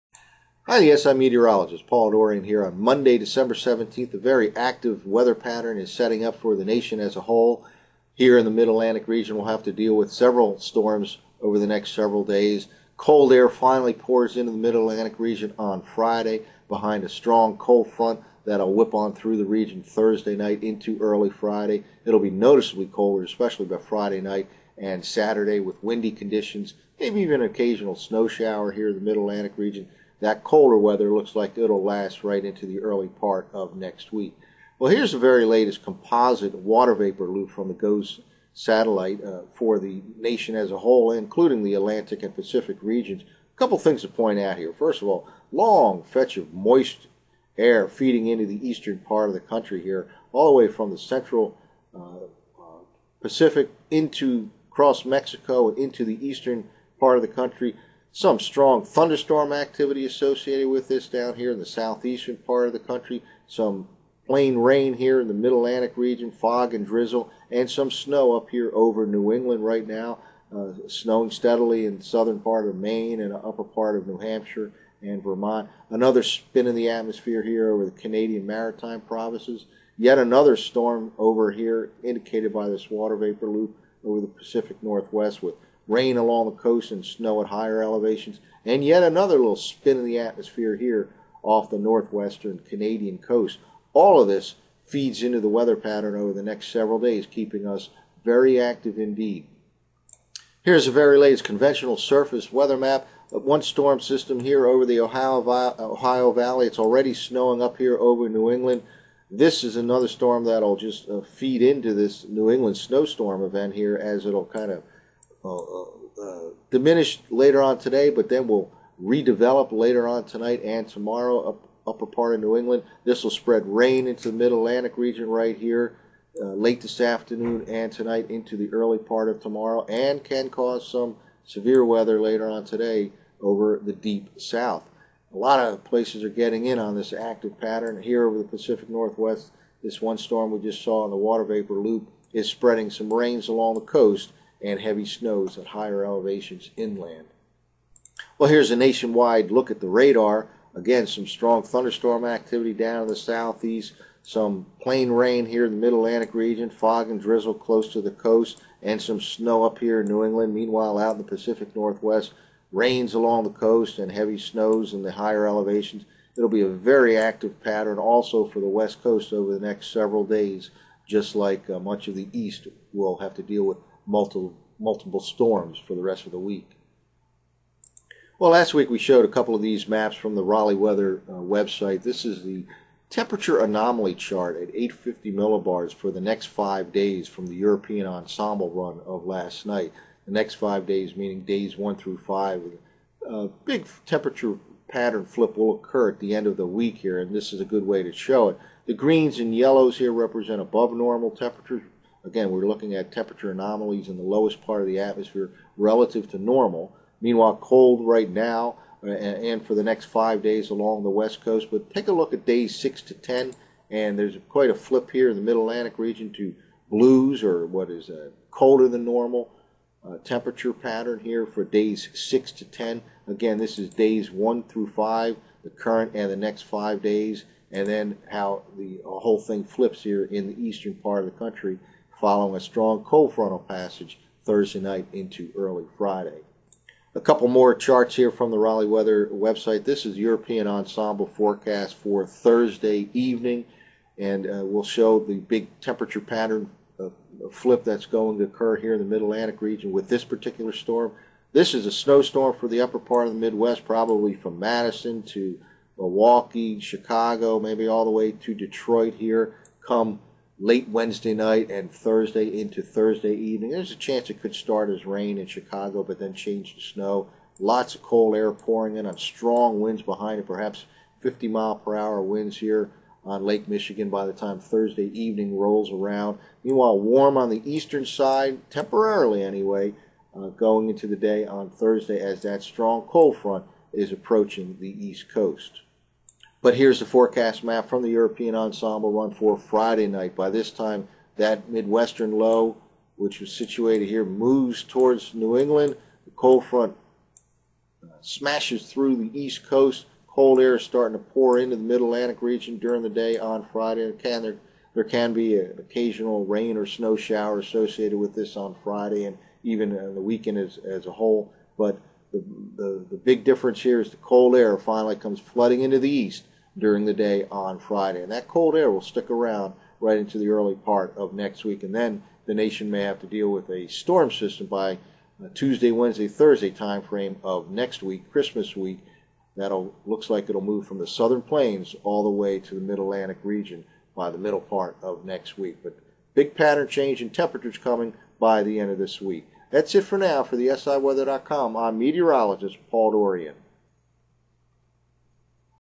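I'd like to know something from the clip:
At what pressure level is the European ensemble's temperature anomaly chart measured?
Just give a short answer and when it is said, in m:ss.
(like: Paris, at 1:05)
850 millibars, at 3:04.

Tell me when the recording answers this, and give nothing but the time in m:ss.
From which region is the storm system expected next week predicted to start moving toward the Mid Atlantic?
5:31.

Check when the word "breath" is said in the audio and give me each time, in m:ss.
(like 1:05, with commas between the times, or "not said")
not said.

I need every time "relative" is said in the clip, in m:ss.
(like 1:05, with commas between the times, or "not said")
3:25.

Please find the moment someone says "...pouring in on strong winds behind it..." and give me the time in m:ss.
4:28.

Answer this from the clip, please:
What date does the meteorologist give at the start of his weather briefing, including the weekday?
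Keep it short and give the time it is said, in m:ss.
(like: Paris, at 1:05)
Monday, December 17th, at 0:02.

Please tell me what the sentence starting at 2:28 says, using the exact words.
Well, here's a nationwide look at the radar.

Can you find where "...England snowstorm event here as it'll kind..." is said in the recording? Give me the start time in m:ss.
1:52.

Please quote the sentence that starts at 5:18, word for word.
And that cold air will stick around right into the early part of next week.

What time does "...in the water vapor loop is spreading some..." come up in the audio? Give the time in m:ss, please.
2:21.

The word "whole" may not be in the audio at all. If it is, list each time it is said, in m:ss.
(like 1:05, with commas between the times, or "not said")
0:07, 0:40, 3:49, 5:11.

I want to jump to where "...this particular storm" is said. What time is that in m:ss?
4:10.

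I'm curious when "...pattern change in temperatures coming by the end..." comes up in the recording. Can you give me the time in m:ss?
5:36.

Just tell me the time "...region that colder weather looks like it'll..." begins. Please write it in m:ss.
0:29.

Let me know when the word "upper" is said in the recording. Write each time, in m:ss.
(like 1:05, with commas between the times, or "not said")
1:13, 2:01, 4:12.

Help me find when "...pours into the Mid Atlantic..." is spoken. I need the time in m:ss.
0:13.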